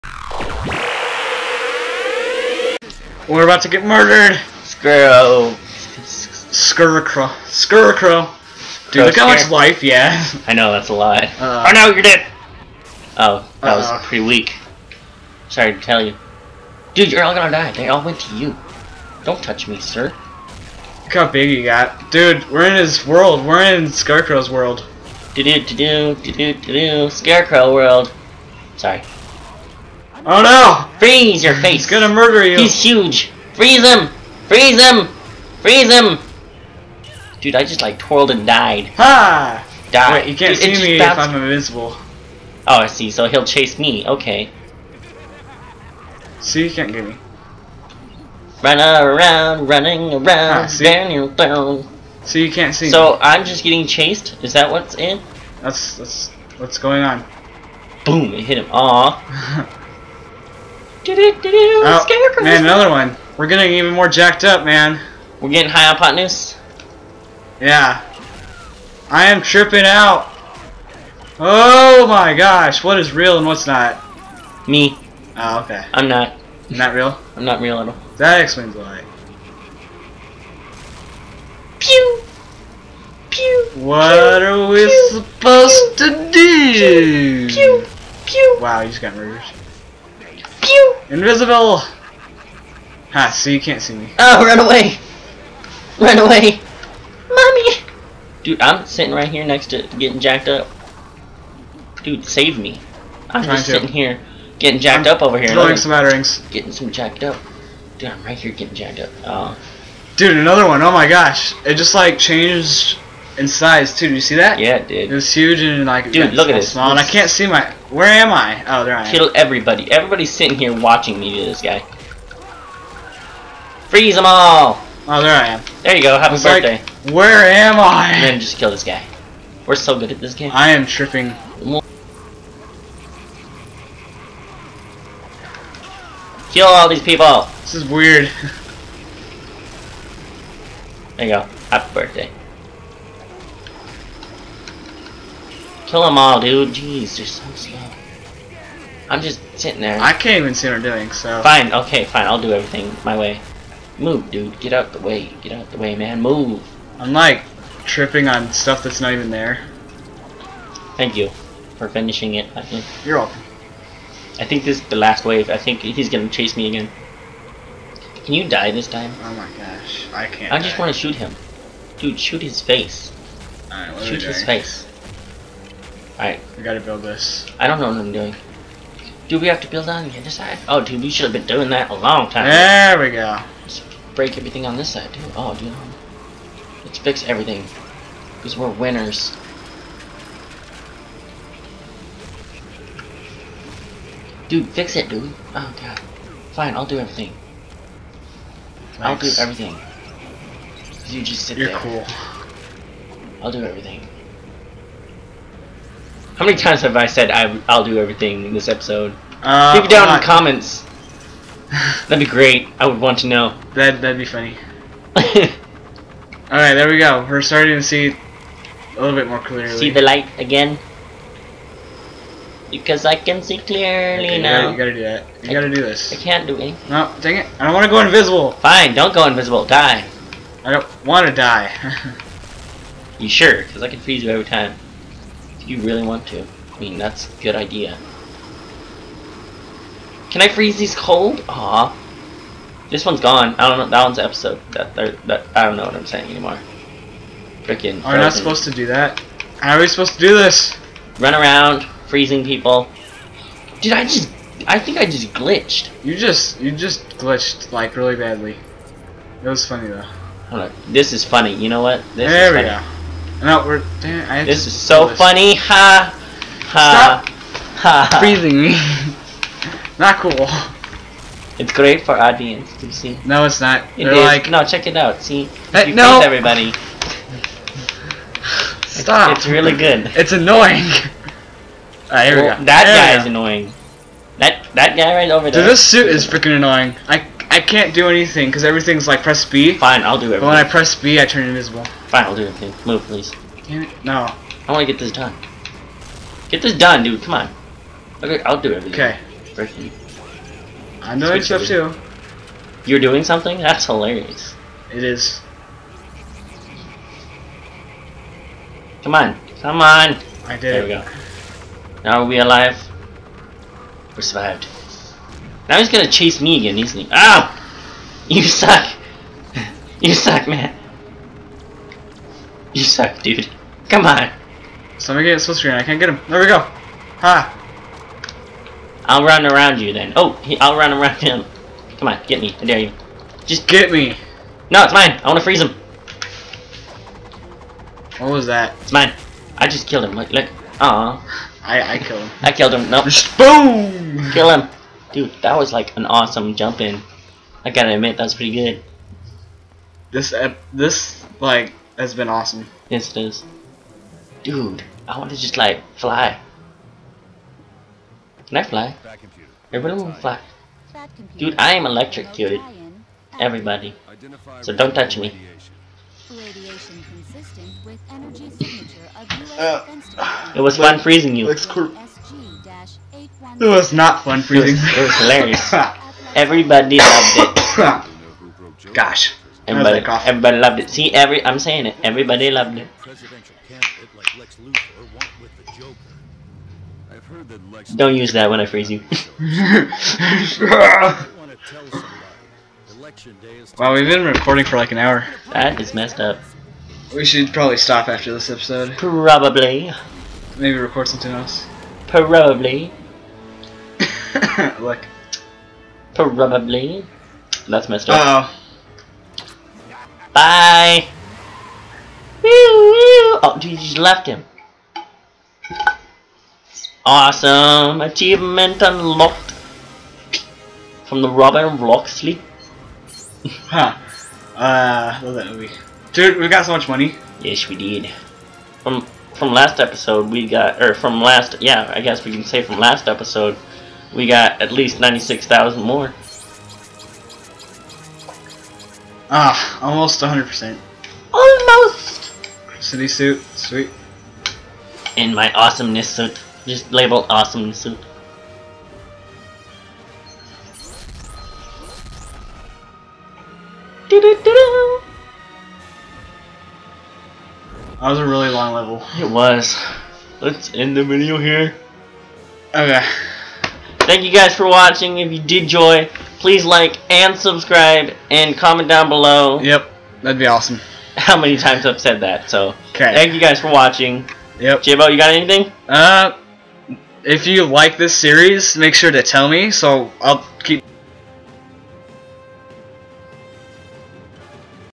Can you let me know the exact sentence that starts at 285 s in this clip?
Dude, this suit is freaking annoying.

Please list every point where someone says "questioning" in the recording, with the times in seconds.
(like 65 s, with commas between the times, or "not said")
not said.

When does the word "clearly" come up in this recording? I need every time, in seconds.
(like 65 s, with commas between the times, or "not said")
219 s, 223 s.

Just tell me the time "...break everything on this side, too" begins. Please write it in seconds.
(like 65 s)
184 s.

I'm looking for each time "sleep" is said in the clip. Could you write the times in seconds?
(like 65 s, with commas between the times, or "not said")
422 s.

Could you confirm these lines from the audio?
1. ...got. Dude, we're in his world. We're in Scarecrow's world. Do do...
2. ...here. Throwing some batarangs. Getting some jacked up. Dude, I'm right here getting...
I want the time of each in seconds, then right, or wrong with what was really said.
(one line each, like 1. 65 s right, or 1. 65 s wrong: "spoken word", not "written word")
1. 21 s right
2. 105 s right.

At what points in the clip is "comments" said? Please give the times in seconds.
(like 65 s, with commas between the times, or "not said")
210 s, 468 s.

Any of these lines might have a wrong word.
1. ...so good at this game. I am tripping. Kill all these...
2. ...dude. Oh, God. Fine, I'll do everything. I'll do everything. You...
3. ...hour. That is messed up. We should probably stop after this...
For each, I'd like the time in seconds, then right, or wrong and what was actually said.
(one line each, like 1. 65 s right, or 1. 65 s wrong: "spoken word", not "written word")
1. 129 s right
2. 195 s right
3. 394 s right.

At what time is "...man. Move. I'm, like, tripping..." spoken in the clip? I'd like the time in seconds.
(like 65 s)
155 s.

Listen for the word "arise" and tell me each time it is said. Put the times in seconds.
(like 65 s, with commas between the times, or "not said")
not said.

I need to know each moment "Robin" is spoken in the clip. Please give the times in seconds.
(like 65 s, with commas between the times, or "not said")
421 s.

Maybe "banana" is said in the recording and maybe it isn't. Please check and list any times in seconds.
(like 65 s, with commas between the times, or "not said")
not said.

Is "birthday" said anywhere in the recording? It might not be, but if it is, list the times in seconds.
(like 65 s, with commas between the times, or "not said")
126 s, 141 s.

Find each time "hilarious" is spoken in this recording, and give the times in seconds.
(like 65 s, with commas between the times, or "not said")
303 s, 375 s.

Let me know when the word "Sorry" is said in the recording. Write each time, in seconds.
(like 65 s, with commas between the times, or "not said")
15 s, 28 s.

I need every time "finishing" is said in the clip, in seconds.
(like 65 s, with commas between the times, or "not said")
161 s.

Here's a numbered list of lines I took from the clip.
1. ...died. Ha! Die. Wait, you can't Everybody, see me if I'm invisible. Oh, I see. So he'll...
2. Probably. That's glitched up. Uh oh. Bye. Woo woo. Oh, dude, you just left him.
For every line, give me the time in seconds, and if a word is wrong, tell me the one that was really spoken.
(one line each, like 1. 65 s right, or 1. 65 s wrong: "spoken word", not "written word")
1. 38 s wrong: "Dude", not "Everybody"
2. 406 s wrong: "messed", not "glitched".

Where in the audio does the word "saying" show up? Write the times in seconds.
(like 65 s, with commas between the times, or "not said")
246 s, 381 s.